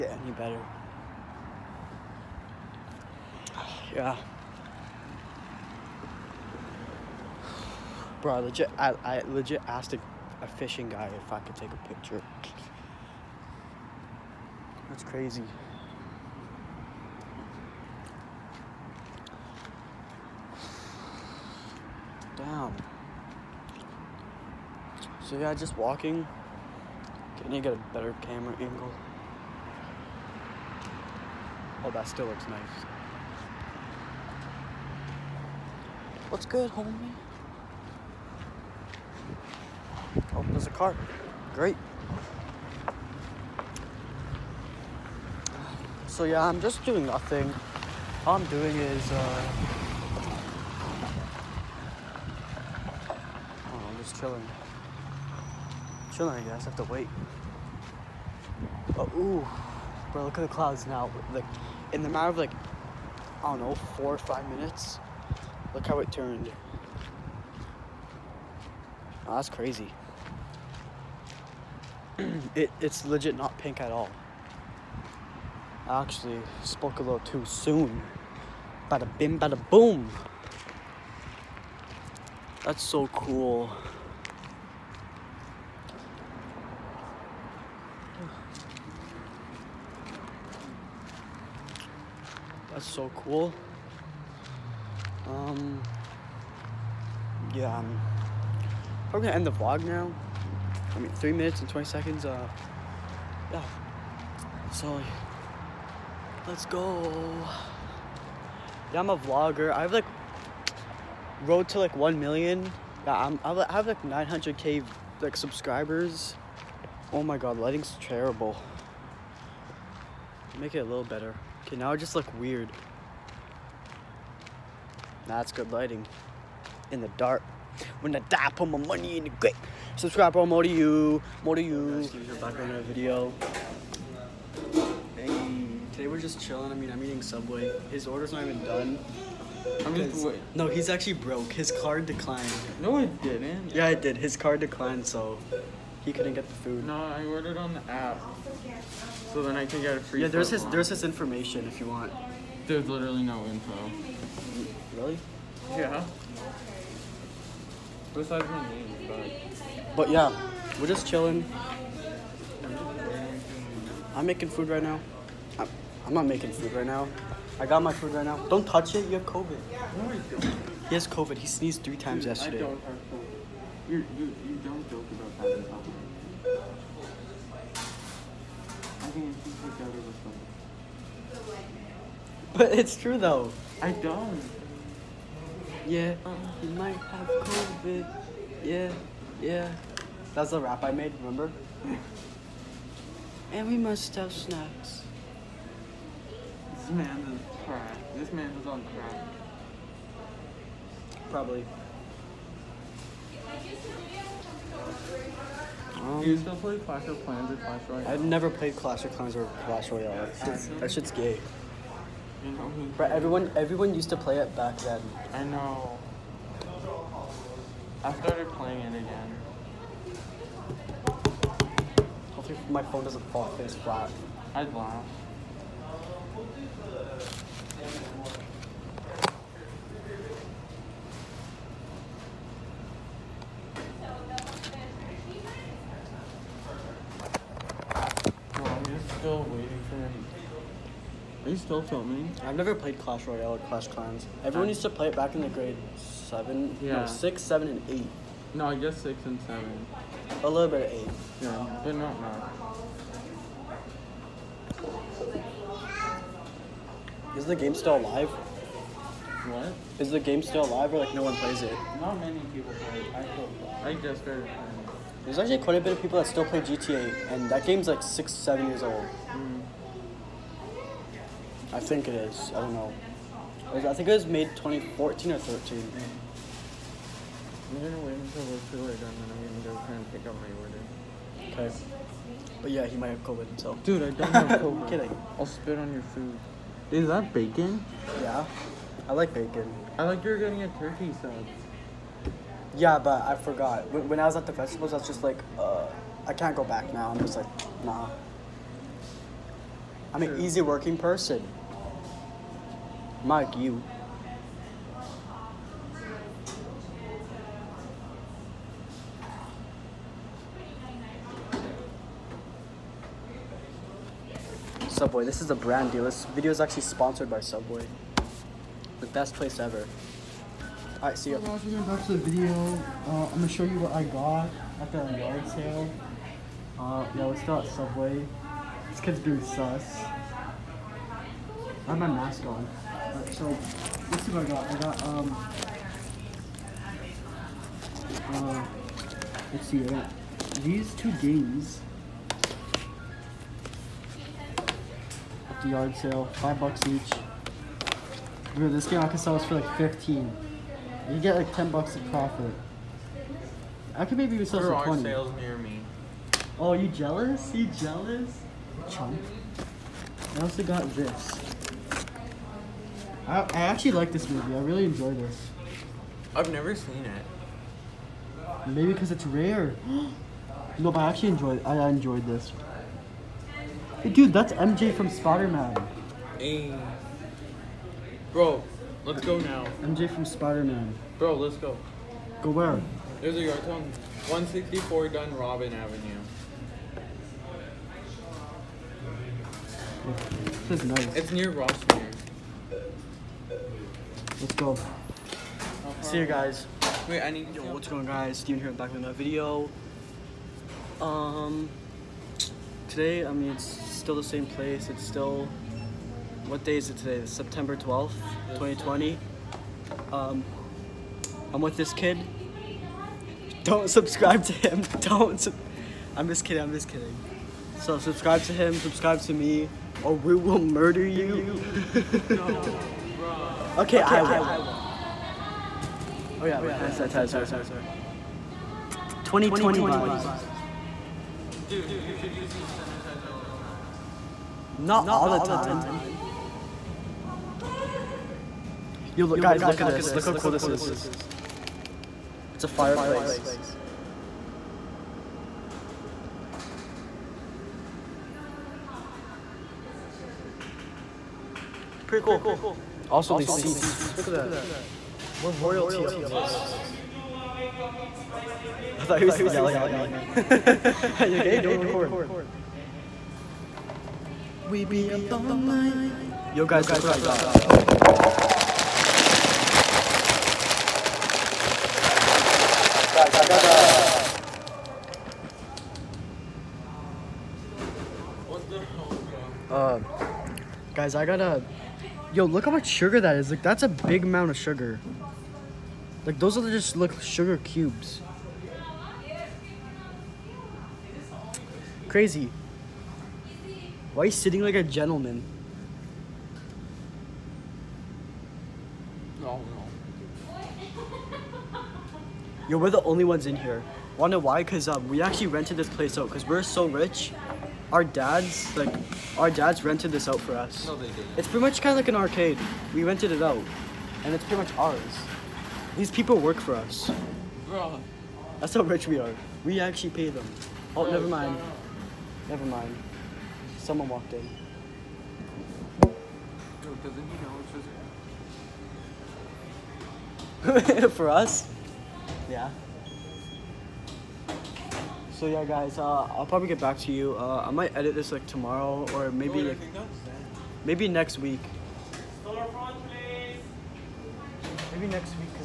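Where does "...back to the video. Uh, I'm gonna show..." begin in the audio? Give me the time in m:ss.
5:21.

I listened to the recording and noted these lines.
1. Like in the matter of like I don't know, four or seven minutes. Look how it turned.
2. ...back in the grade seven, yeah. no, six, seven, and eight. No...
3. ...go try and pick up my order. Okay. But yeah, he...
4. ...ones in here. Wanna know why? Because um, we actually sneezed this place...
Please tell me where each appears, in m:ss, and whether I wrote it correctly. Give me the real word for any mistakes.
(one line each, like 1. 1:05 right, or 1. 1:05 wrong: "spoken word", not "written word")
1. 1:01 wrong: "five", not "seven"
2. 4:05 right
3. 4:39 right
4. 8:23 wrong: "rented", not "sneezed".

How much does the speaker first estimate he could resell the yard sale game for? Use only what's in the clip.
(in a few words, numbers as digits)
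15.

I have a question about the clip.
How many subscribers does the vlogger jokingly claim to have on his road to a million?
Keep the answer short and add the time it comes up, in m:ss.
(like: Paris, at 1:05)
900k, at 1:54.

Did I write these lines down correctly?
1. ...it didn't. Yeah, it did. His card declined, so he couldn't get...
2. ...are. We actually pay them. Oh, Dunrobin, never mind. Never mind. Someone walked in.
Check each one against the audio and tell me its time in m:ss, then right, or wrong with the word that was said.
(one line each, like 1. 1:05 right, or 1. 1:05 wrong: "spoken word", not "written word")
1. 2:22 right
2. 8:39 wrong: "Bro", not "Dunrobin".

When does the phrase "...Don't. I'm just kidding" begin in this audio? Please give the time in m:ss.
6:55.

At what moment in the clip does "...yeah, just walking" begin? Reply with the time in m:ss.
0:25.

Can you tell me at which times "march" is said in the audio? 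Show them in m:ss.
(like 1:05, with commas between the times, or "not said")
not said.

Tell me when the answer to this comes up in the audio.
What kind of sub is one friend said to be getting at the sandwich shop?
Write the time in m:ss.
4:50.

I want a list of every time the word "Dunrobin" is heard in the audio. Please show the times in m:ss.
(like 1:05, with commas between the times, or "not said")
6:25.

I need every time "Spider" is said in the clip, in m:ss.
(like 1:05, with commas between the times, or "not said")
6:15, 6:20.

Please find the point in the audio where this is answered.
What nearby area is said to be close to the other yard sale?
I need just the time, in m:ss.
6:31.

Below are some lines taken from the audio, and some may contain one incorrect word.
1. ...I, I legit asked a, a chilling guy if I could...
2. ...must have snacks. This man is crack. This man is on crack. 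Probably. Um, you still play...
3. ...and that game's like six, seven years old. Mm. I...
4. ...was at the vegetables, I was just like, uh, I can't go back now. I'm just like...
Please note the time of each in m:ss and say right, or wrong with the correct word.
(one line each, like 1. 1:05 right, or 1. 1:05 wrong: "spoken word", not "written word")
1. 0:08 wrong: "fishing", not "chilling"
2. 3:13 right
3. 4:27 right
4. 4:54 right.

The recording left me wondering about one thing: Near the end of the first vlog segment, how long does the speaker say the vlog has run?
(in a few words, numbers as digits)
3 minutes and 20 seconds.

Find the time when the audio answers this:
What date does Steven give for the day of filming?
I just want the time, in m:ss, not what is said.
6:47.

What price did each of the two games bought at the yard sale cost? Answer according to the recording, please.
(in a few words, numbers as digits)
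5 bucks.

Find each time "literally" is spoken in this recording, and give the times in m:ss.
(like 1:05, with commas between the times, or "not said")
2:32.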